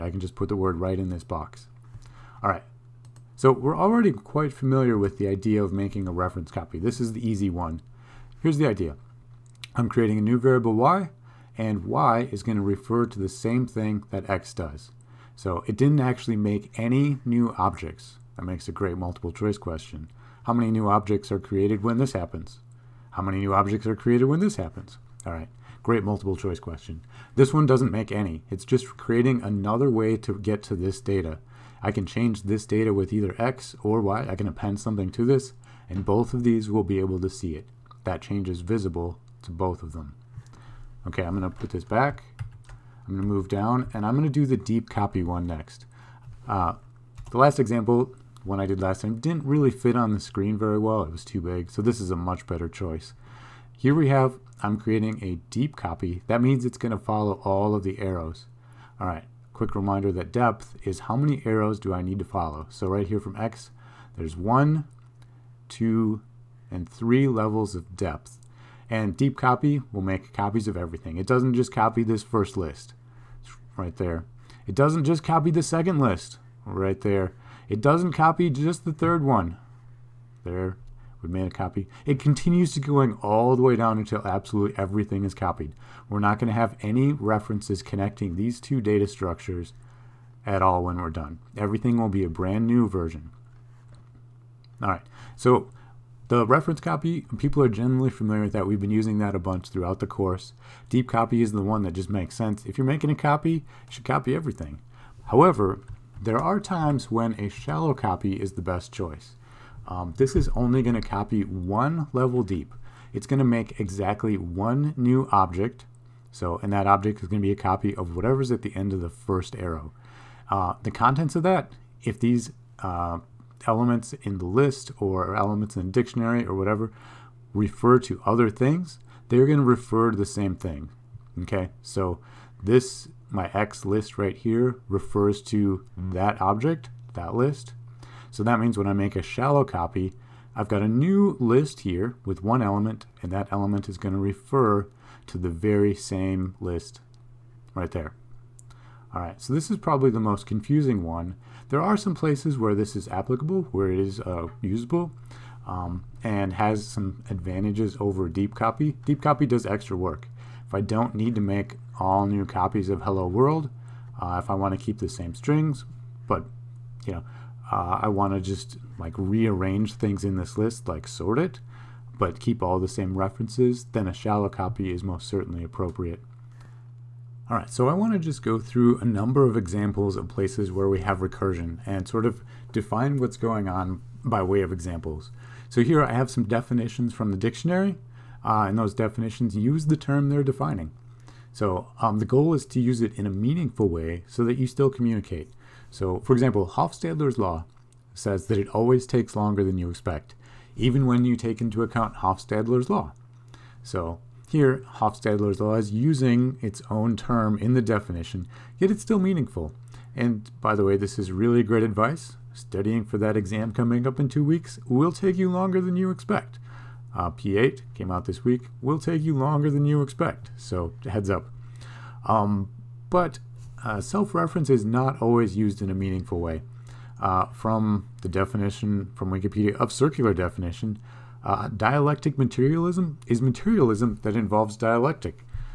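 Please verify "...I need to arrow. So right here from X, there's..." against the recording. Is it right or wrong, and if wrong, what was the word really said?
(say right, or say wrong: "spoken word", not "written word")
wrong: "follow", not "arrow".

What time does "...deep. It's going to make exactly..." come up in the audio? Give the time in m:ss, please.
1:52.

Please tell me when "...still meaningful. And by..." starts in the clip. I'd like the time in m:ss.
3:29.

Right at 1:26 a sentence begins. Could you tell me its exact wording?
We're not going to have any references connecting these two data structures at all when we're done.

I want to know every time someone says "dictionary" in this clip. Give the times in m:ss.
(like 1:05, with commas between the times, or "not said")
2:05, 3:07.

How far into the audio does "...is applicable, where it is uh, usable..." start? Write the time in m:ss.
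2:32.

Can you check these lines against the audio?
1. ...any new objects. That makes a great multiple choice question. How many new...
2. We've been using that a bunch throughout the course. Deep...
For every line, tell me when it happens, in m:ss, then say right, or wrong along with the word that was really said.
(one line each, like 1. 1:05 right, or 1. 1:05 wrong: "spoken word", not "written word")
1. 0:16 right
2. 1:38 right.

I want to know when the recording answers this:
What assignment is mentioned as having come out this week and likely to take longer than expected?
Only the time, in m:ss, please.
3:37.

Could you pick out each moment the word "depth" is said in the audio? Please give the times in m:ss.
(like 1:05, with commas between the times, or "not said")
1:00, 1:07.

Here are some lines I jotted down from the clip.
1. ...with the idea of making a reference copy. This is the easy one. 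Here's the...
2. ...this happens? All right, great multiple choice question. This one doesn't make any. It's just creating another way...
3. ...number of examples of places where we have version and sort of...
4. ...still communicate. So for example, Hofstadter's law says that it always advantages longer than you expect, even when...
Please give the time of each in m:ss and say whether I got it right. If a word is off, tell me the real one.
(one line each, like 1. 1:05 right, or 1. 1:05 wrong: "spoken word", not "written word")
1. 0:04 right
2. 0:24 right
3. 2:59 wrong: "recursion", not "version"
4. 3:14 wrong: "takes", not "advantages".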